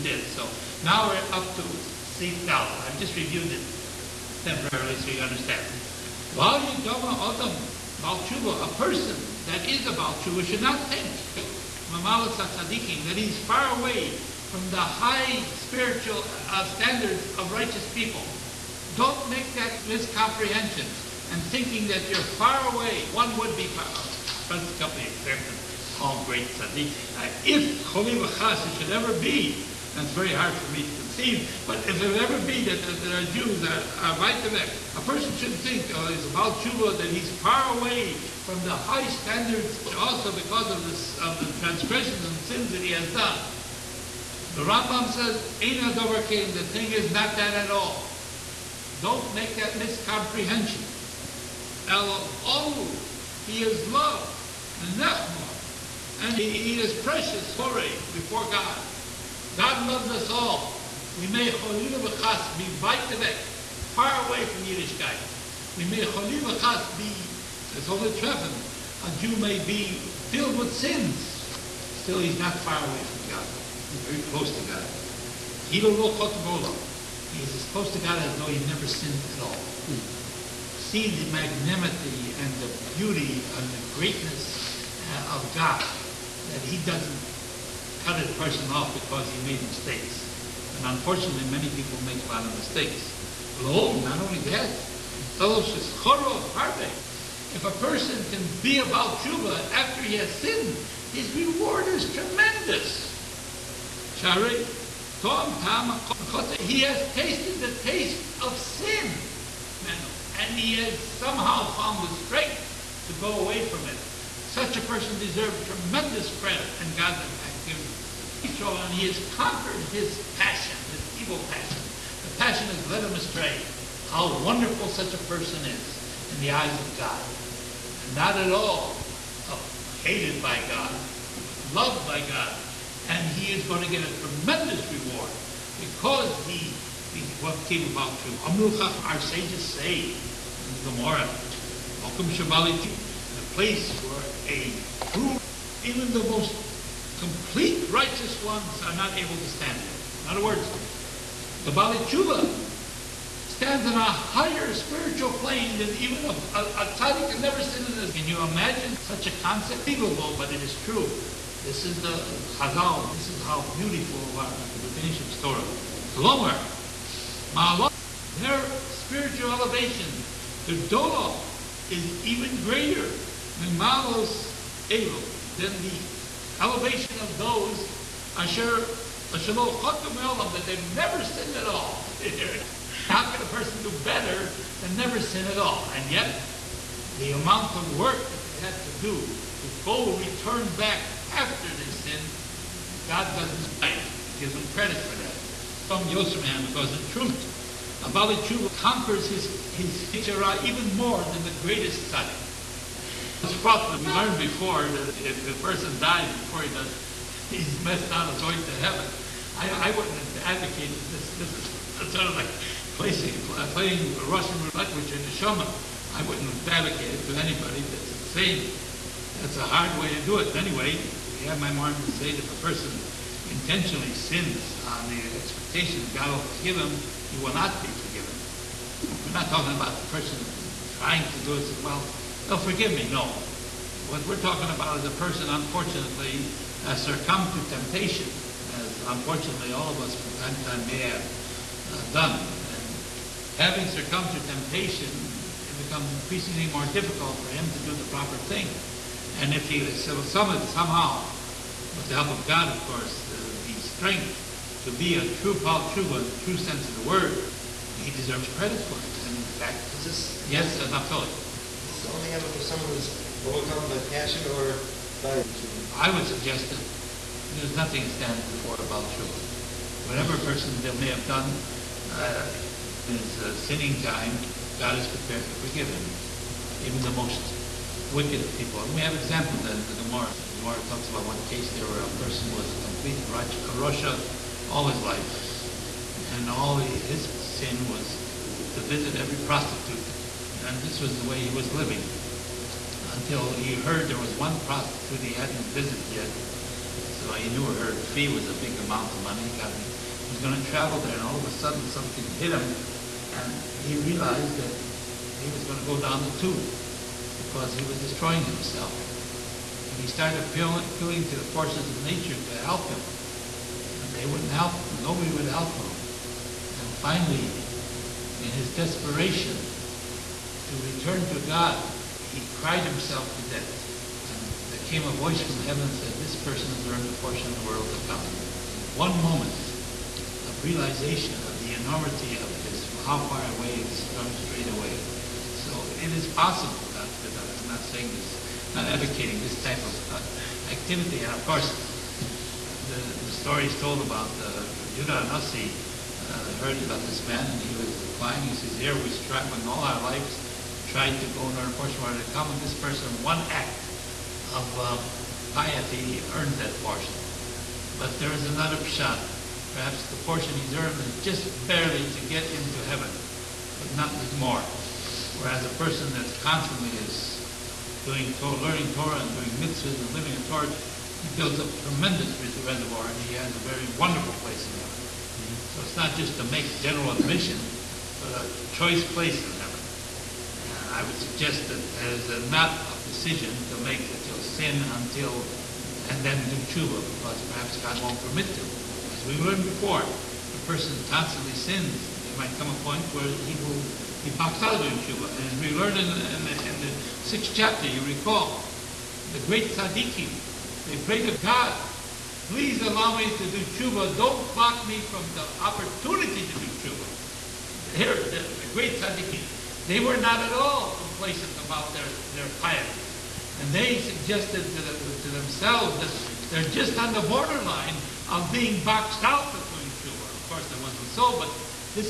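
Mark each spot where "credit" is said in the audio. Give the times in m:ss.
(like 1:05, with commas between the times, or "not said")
1:56, 3:14, 4:18.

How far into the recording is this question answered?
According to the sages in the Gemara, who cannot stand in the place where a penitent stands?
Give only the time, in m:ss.
2:25.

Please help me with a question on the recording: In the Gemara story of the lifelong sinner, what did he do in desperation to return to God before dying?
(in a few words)
cried himself to death.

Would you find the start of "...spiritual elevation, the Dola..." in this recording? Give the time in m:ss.
2:48.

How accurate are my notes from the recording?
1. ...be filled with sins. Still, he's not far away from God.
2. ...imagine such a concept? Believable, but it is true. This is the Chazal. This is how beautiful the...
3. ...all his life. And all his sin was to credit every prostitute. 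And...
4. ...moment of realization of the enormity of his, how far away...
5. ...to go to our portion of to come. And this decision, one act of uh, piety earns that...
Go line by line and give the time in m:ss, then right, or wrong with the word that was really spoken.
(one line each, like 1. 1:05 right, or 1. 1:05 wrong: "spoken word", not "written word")
1. 1:09 right
2. 2:38 right
3. 4:44 wrong: "visit", not "credit"
4. 5:29 right
5. 5:51 wrong: "person", not "decision".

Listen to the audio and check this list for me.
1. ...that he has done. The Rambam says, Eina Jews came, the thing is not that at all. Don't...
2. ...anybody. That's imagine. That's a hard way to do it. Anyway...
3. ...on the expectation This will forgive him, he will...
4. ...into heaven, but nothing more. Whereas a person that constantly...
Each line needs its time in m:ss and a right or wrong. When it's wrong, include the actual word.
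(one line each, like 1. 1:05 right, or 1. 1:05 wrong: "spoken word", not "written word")
1. 0:42 wrong: "Dover", not "Jews"
2. 3:37 wrong: "insane", not "imagine"
3. 3:44 wrong: "God", not "This"
4. 6:02 right.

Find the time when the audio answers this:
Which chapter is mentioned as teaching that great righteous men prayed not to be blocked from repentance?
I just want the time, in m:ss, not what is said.
6:37.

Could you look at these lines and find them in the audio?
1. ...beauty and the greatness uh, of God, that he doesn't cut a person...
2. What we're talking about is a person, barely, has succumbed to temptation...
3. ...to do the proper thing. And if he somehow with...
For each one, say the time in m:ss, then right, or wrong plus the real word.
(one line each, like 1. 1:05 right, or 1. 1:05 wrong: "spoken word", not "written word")
1. 1:22 right
2. 3:54 wrong: "unfortunately", not "barely"
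3. 4:07 right.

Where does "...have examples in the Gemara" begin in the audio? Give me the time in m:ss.
4:39.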